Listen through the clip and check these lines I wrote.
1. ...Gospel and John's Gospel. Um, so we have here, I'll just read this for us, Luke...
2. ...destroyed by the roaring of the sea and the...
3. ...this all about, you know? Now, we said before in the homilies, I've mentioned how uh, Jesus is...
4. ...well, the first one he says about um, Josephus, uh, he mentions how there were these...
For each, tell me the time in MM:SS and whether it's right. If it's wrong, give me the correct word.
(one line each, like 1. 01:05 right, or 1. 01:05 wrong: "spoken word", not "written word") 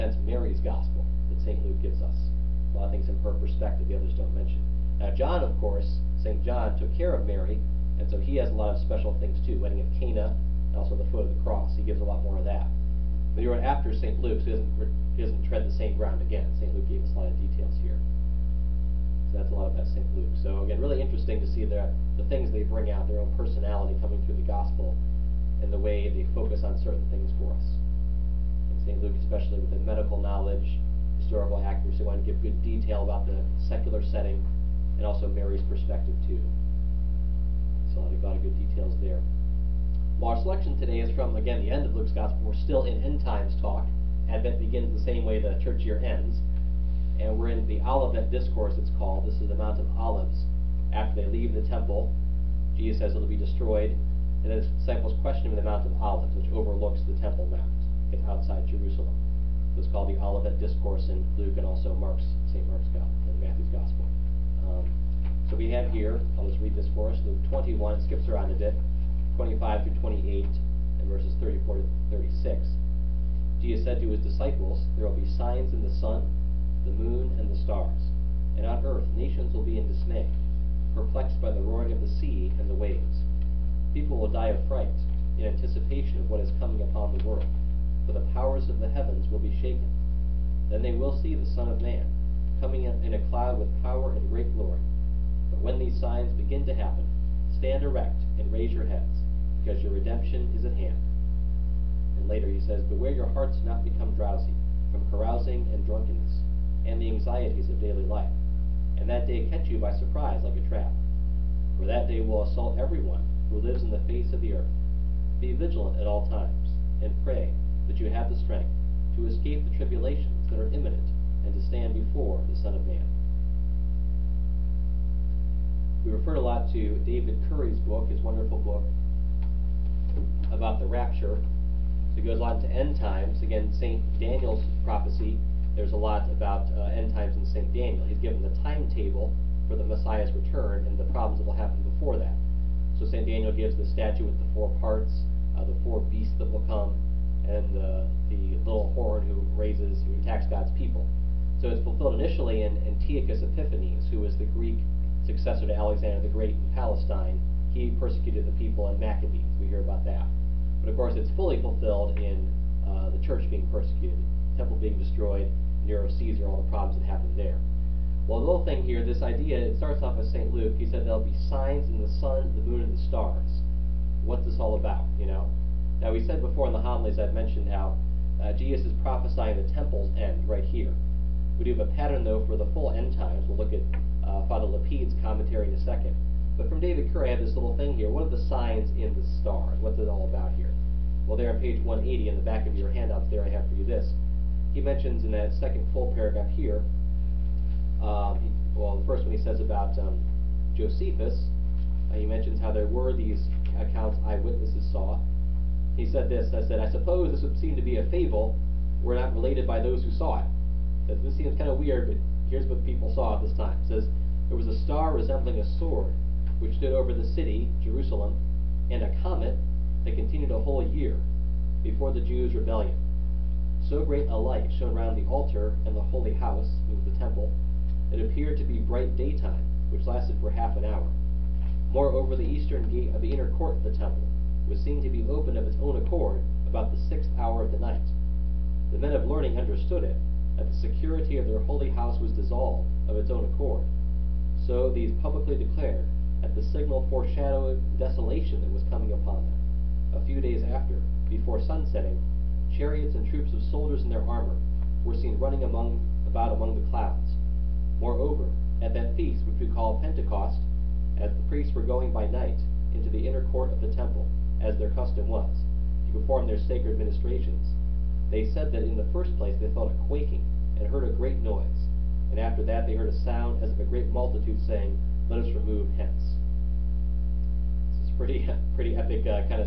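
1. 01:02 wrong: "Matthew", not "John"
2. 01:20 wrong: "perplexed", not "destroyed"
3. 02:54 right
4. 03:18 right.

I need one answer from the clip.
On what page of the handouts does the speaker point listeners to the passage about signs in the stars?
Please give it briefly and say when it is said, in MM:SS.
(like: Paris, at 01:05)
180, at 03:11.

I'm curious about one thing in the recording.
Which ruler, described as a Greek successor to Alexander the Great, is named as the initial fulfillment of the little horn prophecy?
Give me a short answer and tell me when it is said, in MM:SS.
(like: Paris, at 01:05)
Antiochus Epiphanes, at 02:32.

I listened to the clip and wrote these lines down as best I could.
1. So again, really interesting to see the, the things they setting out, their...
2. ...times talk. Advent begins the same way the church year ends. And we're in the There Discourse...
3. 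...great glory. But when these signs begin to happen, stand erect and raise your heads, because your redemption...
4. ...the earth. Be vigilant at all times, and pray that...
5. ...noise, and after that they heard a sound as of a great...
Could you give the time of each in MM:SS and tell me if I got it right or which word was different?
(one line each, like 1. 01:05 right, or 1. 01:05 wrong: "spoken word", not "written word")
1. 00:20 wrong: "bring", not "setting"
2. 00:43 wrong: "Olivet", not "There"
3. 01:34 right
4. 01:54 right
5. 04:31 right.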